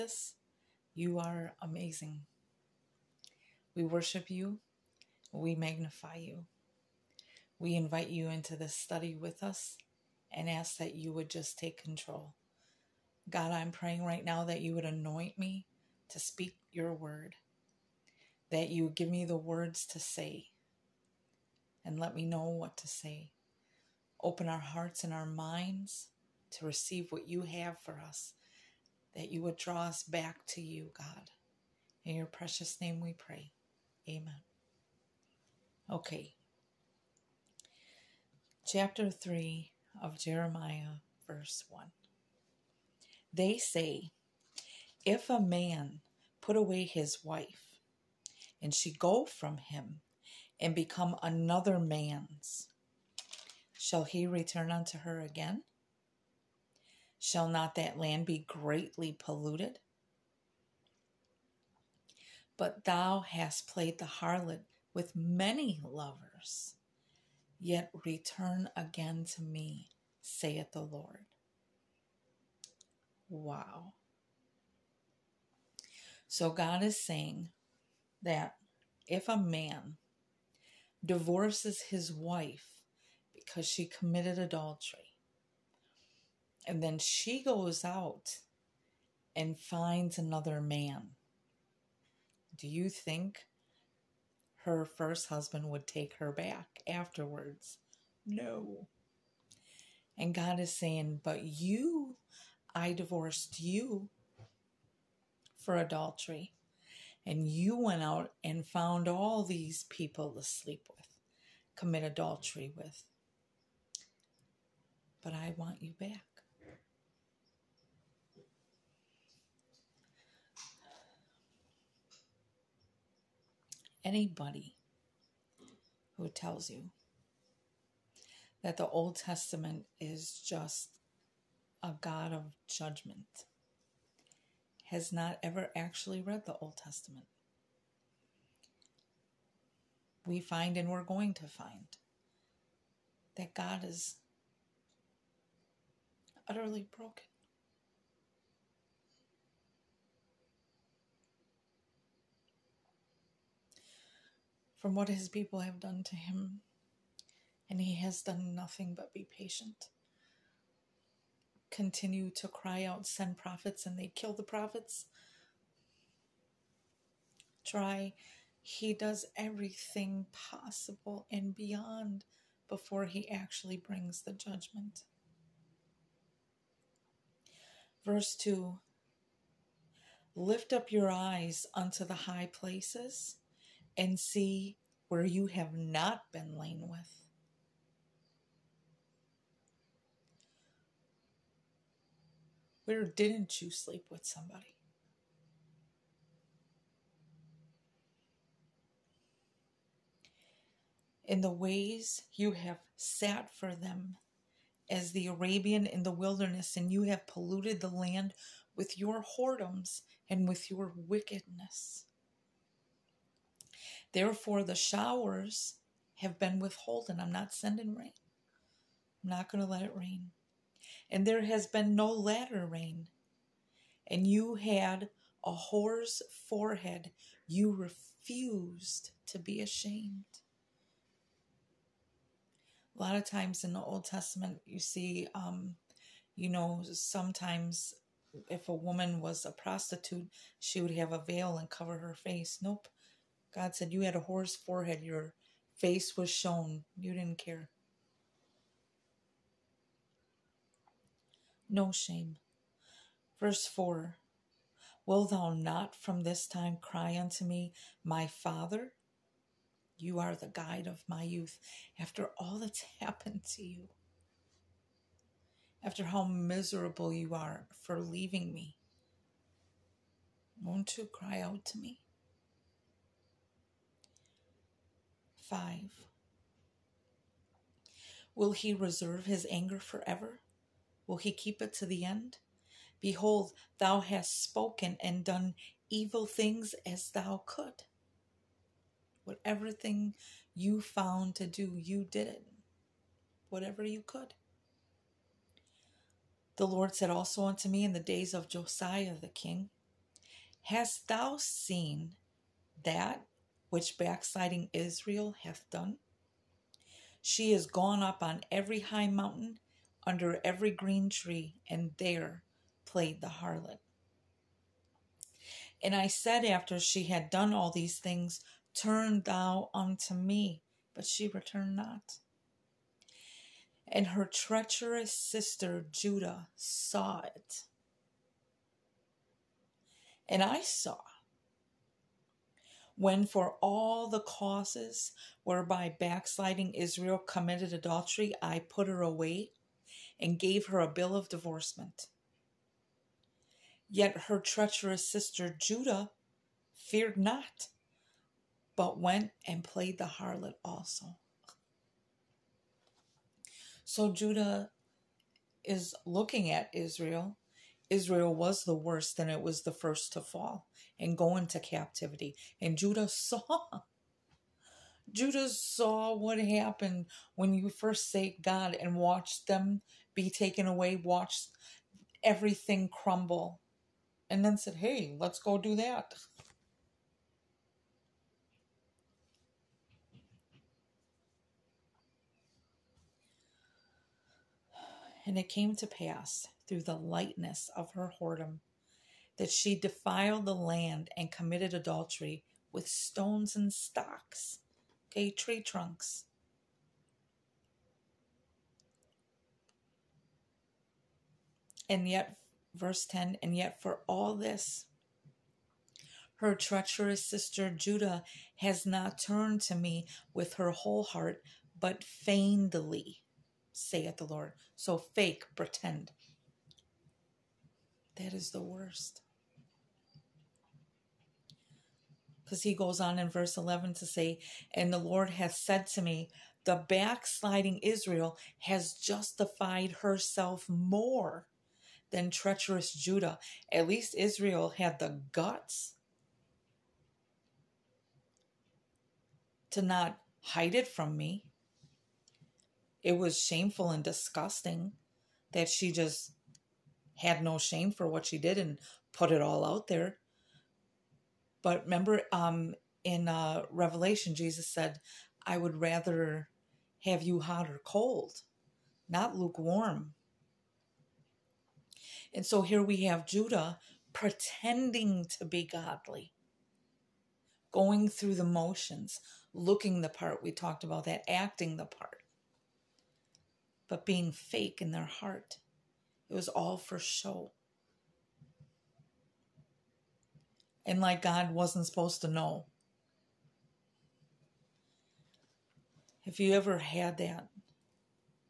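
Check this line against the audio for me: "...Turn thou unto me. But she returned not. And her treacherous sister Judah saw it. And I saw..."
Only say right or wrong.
right.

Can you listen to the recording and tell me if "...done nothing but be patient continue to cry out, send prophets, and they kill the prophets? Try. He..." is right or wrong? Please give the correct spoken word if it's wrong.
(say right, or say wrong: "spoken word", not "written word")
right.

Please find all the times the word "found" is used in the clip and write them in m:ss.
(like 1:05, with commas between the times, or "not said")
1:48, 4:50.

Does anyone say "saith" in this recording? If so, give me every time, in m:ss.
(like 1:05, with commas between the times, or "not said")
1:10, 6:53.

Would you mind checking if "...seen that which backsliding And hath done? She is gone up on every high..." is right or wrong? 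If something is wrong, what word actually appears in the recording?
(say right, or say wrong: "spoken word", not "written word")
wrong: "Israel", not "And".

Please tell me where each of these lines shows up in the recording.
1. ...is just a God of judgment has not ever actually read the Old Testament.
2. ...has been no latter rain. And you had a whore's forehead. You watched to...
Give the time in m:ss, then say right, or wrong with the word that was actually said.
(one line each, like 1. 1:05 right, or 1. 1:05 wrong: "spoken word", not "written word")
1. 2:10 right
2. 3:41 wrong: "refused", not "watched".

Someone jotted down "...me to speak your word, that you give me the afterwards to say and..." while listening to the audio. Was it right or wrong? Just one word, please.
wrong.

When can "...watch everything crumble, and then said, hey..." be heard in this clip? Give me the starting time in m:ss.
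6:10.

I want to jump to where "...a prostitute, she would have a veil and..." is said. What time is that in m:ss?
3:59.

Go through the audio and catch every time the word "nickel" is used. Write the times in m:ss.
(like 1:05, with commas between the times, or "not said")
not said.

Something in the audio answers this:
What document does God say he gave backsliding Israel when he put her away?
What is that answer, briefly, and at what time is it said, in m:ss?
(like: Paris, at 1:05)
bill of divorcement, at 5:40.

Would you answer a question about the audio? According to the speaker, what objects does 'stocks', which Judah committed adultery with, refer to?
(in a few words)
tree trunks.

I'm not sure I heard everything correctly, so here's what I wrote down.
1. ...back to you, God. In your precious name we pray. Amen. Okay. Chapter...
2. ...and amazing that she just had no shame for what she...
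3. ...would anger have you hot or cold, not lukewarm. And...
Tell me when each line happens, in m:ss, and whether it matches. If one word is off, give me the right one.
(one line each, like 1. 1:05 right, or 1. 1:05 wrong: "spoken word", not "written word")
1. 0:30 right
2. 7:23 wrong: "disgusting", not "amazing"
3. 7:35 wrong: "rather", not "anger".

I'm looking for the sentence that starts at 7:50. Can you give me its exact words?
We talked about that, acting the part, but being fake in their heart.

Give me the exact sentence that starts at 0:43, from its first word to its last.
They say, If a man put away his wife, and she go from him, and become another man's.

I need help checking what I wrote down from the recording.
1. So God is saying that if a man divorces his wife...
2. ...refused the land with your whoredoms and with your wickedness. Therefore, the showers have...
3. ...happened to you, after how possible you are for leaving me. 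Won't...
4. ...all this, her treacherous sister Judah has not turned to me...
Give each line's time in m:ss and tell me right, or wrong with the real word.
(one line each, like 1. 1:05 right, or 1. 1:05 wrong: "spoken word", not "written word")
1. 1:16 right
2. 3:27 wrong: "polluted", not "refused"
3. 4:23 wrong: "miserable", not "possible"
4. 6:44 right.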